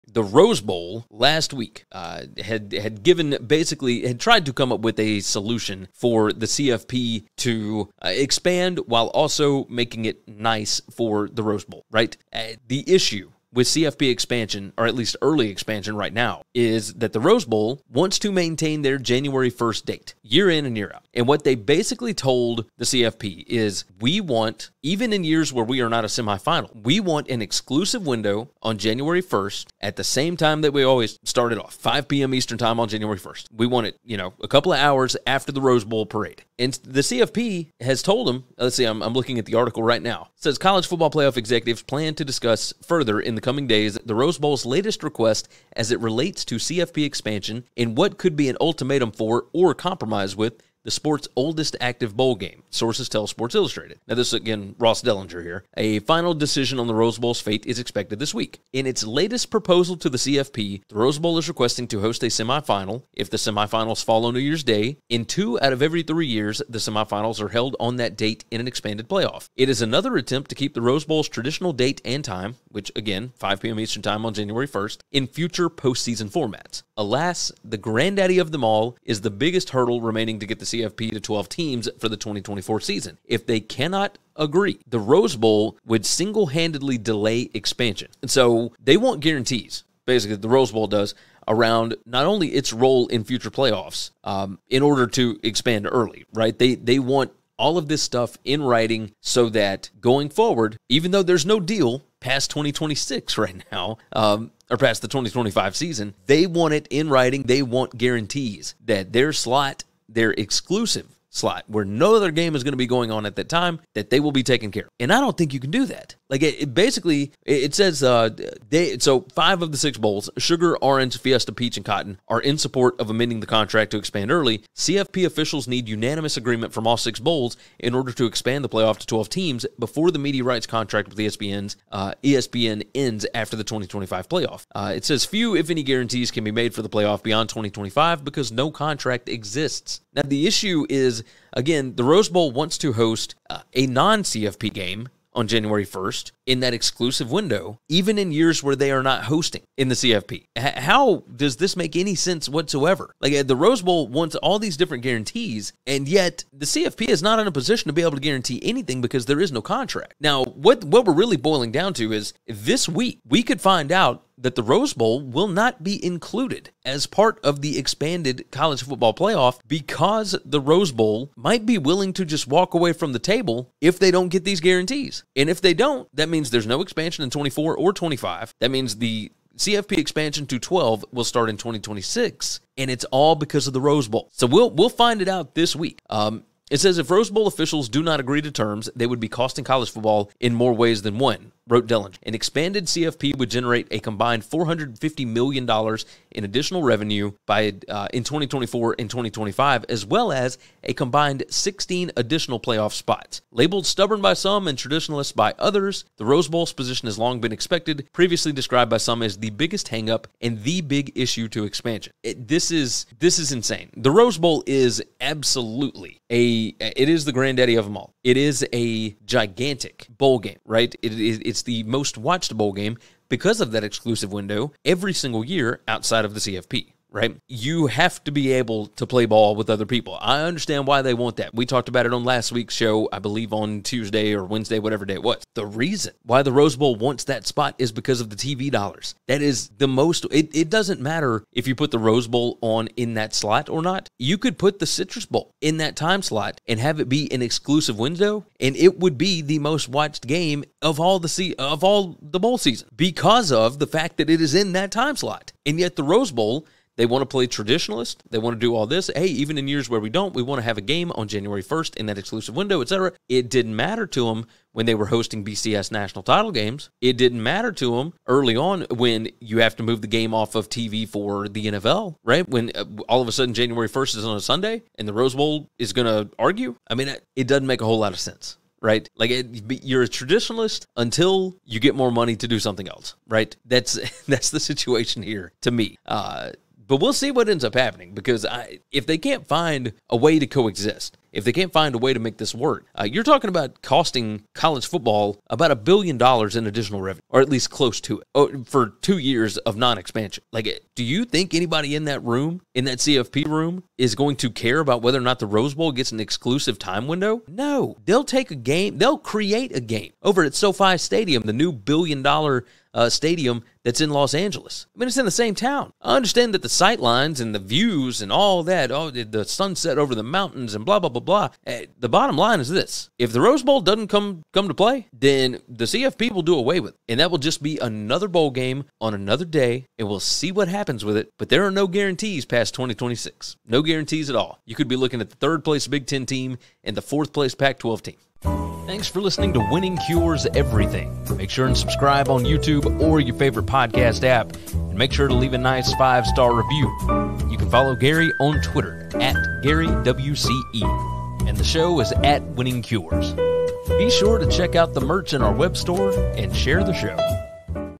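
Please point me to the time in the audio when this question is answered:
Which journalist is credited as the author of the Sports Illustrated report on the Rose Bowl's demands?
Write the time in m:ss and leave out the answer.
0:54.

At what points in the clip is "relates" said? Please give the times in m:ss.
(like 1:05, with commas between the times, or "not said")
0:45.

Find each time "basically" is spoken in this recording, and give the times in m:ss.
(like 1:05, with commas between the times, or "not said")
0:03, 0:21, 1:30, 1:56.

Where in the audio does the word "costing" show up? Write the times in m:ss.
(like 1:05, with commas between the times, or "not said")
3:09, 4:53.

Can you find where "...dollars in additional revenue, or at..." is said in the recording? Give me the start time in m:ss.
4:56.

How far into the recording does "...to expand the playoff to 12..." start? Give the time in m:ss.
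2:08.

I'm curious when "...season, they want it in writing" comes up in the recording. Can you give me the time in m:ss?
1:45.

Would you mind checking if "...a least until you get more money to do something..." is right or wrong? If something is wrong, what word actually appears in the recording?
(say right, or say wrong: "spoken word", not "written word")
wrong: "traditionalist", not "least".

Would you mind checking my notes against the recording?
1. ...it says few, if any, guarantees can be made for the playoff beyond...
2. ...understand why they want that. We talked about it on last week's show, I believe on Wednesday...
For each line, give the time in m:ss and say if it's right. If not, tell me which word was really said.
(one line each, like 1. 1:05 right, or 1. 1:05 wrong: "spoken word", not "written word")
1. 2:14 right
2. 3:50 wrong: "Tuesday", not "Wednesday".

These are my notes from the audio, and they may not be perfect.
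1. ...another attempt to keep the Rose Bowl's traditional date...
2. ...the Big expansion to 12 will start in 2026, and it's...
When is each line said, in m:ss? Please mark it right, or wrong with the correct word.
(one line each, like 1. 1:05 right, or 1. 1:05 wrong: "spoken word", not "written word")
1. 1:09 right
2. 2:58 wrong: "CFP", not "Big".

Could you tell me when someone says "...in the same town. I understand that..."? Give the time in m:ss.
5:15.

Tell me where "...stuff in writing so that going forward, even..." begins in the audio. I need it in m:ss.
1:38.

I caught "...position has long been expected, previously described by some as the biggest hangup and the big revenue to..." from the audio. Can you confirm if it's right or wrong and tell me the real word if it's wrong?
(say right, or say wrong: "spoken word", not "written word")
wrong: "issue", not "revenue".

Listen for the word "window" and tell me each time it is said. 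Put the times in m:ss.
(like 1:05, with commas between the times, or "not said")
0:28, 2:27, 3:44, 4:07, 4:22, 5:07.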